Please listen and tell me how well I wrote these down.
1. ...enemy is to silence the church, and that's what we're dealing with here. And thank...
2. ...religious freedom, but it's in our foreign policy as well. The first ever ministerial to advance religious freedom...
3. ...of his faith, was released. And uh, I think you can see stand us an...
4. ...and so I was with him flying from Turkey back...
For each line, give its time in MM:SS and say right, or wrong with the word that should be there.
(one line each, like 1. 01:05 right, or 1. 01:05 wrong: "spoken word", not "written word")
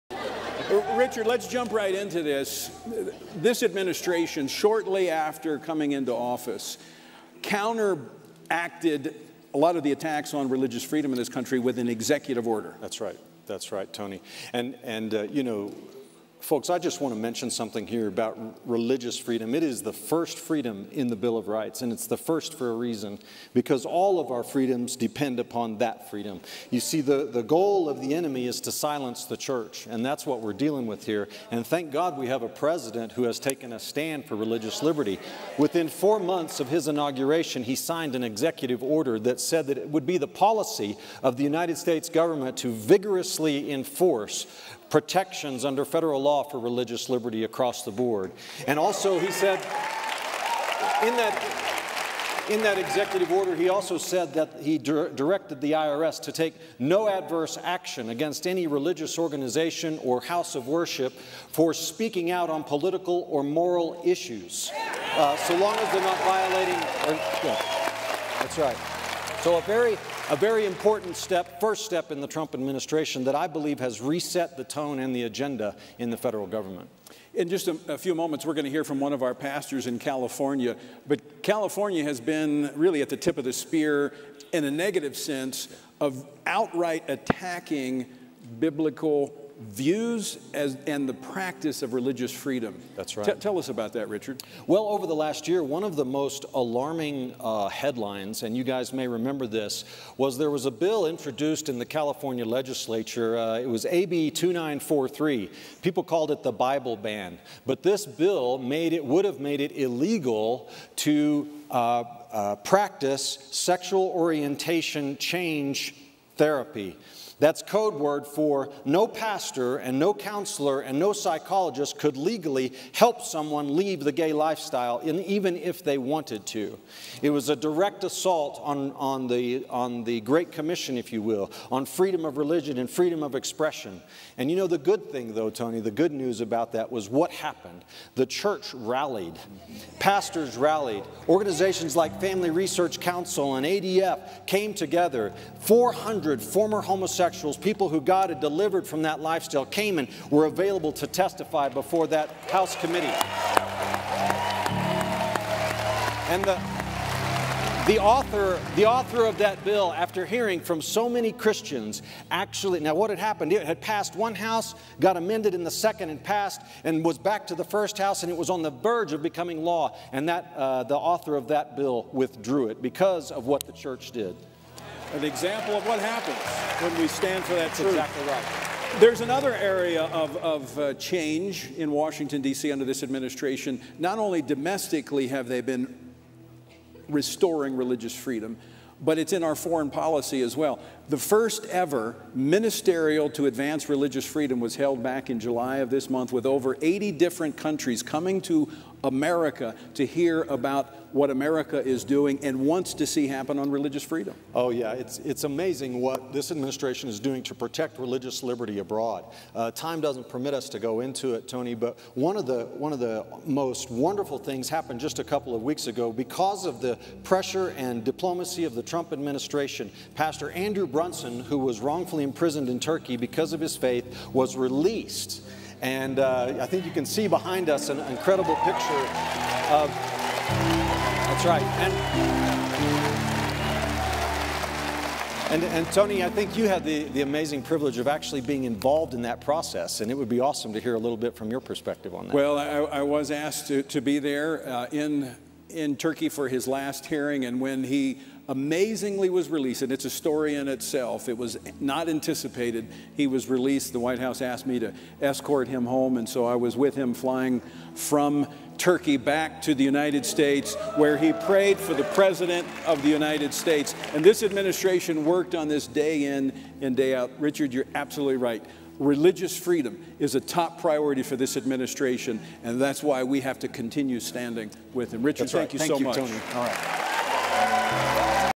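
1. 00:28 right
2. 03:07 right
3. 03:43 wrong: "behind", not "stand"
4. 04:16 right.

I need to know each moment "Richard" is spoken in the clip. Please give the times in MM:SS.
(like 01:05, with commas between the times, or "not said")
00:00, 01:34, 04:27, 04:35.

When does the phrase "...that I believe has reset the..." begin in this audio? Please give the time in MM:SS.
01:13.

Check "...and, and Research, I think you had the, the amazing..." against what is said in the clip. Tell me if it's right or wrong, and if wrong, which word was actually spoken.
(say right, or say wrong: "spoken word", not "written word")
wrong: "Tony", not "Research".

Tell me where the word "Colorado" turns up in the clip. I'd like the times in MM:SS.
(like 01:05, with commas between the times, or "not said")
not said.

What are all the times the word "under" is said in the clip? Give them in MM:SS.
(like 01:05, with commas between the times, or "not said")
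00:45, 03:02.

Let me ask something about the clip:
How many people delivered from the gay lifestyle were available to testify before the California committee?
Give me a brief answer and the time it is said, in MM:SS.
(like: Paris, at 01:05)
400, at 02:25.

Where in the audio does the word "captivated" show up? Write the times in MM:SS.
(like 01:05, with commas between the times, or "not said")
not said.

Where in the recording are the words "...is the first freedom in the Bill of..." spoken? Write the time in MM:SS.
00:19.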